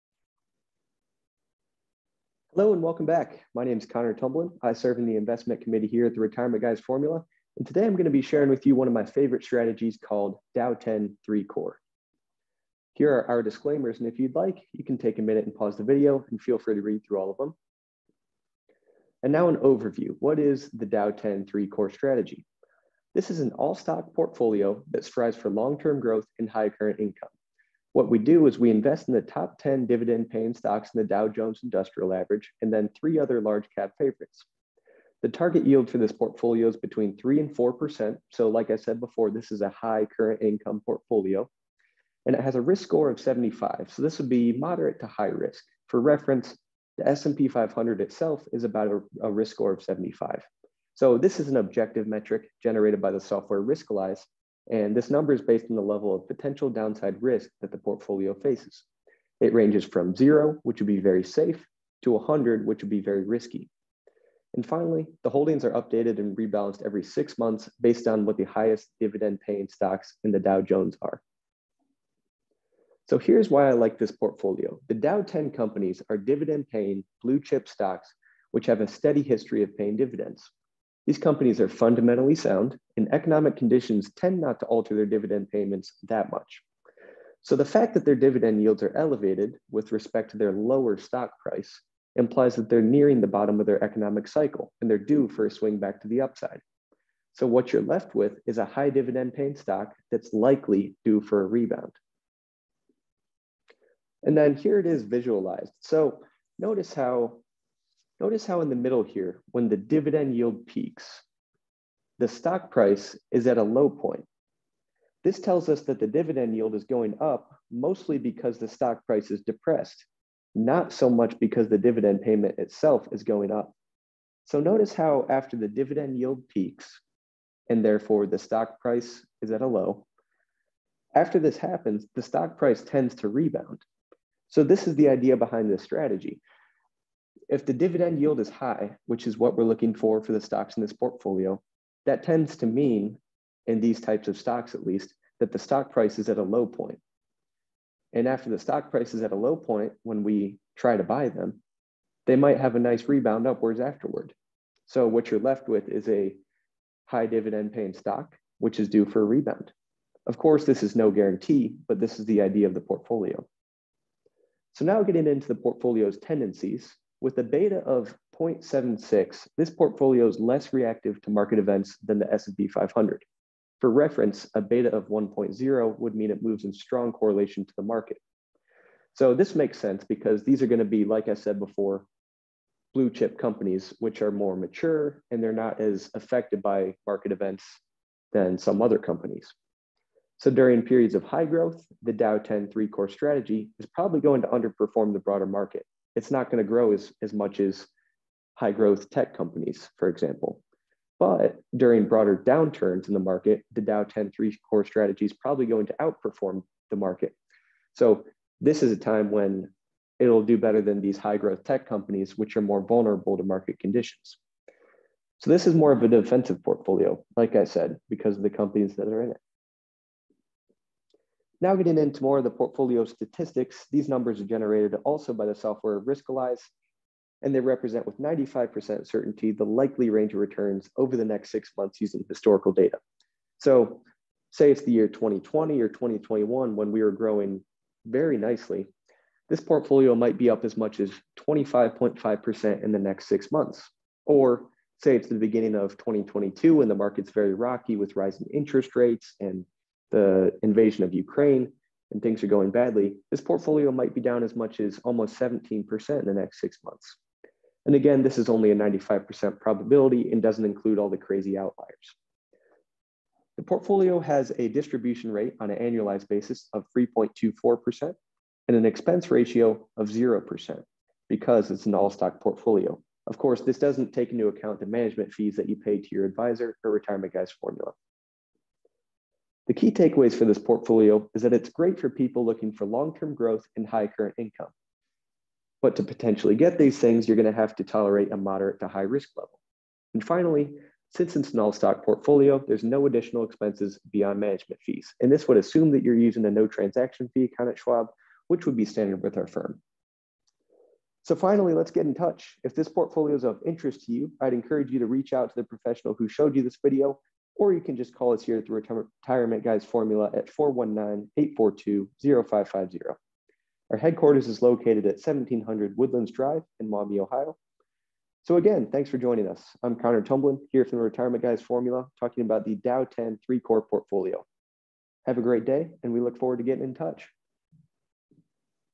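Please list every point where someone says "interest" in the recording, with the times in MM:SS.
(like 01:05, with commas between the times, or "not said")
04:08, 05:03.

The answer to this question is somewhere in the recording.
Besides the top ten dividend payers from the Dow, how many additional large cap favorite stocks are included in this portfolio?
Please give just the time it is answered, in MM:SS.
00:32.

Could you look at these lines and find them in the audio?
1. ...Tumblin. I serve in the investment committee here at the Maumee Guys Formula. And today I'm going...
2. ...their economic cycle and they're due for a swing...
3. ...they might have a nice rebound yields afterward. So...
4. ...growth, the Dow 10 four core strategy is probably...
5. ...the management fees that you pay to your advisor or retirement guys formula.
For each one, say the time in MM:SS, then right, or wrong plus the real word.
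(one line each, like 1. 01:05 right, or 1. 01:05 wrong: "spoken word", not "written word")
1. 00:04 wrong: "Retirement", not "Maumee"
2. 01:33 right
3. 02:32 wrong: "upwards", not "yields"
4. 03:11 wrong: "three", not "four"
5. 04:34 right.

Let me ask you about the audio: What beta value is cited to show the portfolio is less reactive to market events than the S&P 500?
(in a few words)
0.76.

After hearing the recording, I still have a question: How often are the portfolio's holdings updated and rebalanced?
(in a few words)
every six months.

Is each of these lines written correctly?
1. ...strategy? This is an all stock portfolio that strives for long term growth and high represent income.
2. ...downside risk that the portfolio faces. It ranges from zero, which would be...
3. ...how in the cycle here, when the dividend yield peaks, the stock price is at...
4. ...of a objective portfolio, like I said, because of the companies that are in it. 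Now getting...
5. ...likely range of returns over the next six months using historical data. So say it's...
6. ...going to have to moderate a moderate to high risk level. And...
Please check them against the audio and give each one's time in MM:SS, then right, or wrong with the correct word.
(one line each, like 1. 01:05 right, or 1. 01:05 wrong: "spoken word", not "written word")
1. 00:21 wrong: "current", not "represent"
2. 00:56 right
3. 01:48 wrong: "middle", not "cycle"
4. 03:35 wrong: "defensive", not "objective"
5. 03:49 right
6. 04:47 wrong: "tolerate", not "moderate".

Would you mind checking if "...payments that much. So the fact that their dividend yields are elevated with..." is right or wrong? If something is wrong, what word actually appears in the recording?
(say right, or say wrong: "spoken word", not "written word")
right.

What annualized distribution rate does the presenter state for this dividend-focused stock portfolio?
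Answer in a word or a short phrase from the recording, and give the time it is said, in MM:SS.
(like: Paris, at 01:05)
3.24%, at 04:26.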